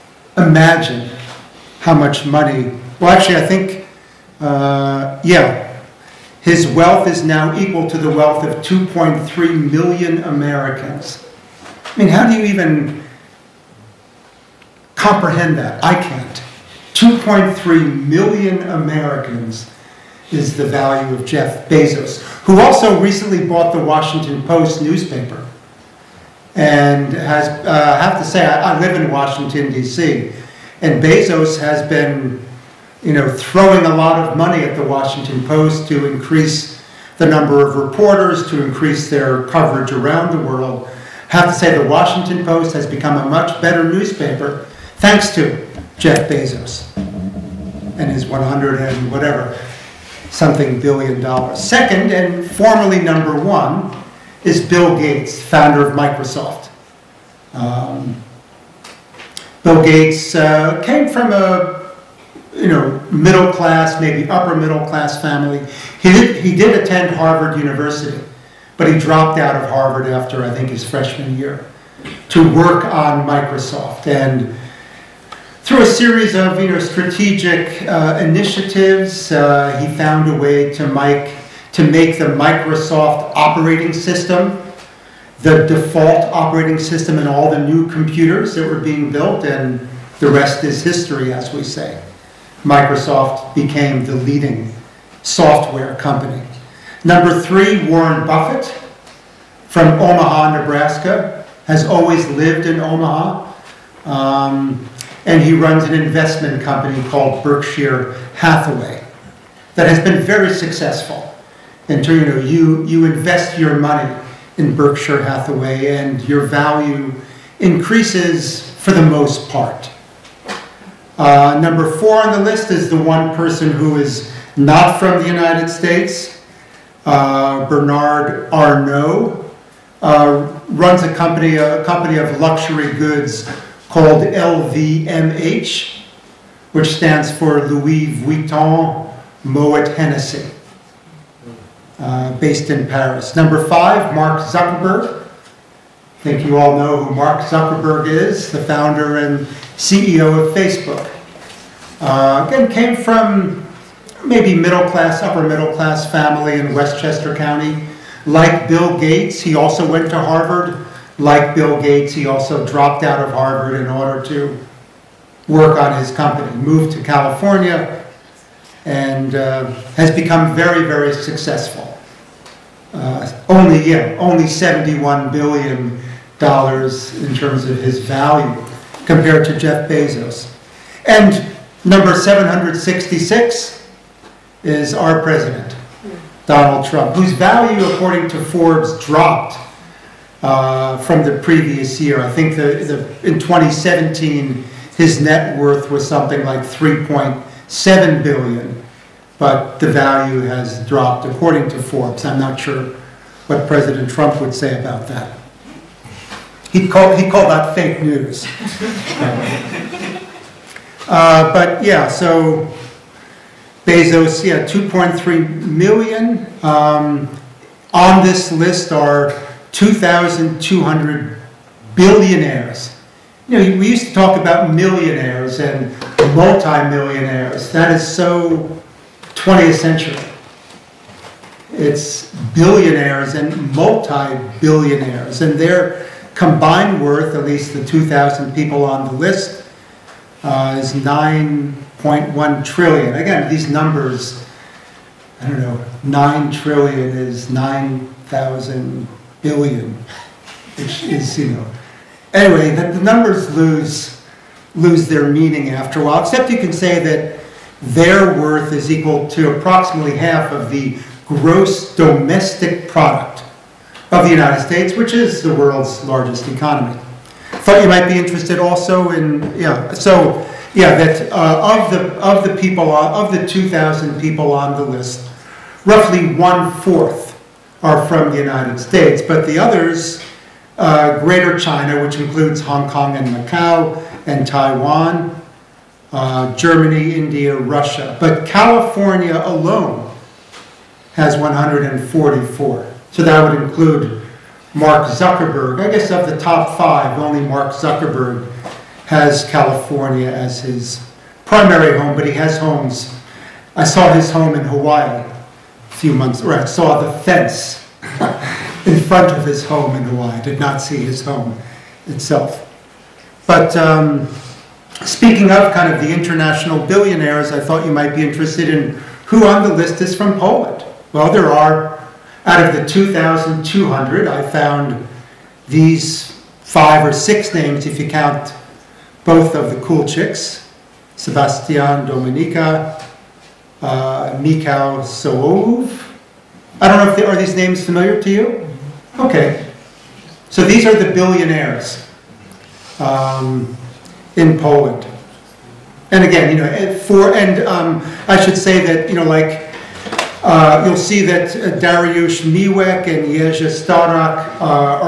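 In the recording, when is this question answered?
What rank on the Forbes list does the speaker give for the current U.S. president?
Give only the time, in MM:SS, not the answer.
03:02.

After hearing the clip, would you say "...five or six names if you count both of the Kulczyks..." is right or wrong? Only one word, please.
right.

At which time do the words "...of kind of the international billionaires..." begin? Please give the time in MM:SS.
05:15.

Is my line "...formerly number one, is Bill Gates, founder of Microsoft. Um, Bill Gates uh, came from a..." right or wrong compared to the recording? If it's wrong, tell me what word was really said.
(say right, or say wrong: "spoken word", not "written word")
right.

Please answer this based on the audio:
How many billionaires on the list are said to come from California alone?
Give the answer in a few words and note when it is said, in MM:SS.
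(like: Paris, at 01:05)
144, at 04:51.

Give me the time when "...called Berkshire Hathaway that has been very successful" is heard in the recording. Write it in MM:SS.
01:47.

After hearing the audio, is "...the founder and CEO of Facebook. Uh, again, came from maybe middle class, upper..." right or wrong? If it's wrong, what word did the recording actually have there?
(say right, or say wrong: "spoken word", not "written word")
right.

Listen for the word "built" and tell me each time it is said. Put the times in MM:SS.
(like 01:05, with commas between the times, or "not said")
01:29.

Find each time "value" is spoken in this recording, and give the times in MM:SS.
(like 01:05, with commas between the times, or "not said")
00:20, 01:56, 02:58, 03:07, 03:19.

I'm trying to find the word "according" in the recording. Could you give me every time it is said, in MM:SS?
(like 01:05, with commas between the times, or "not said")
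03:07, 03:21.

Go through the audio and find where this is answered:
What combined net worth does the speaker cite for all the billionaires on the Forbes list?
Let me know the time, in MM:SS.
04:00.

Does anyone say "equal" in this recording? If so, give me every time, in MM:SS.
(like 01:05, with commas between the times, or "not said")
00:07, 04:18.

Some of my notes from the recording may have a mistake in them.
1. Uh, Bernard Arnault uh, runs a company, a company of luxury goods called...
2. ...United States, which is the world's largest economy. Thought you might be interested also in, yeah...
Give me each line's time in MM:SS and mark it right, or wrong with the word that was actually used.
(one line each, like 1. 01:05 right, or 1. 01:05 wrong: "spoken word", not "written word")
1. 02:07 right
2. 04:24 right.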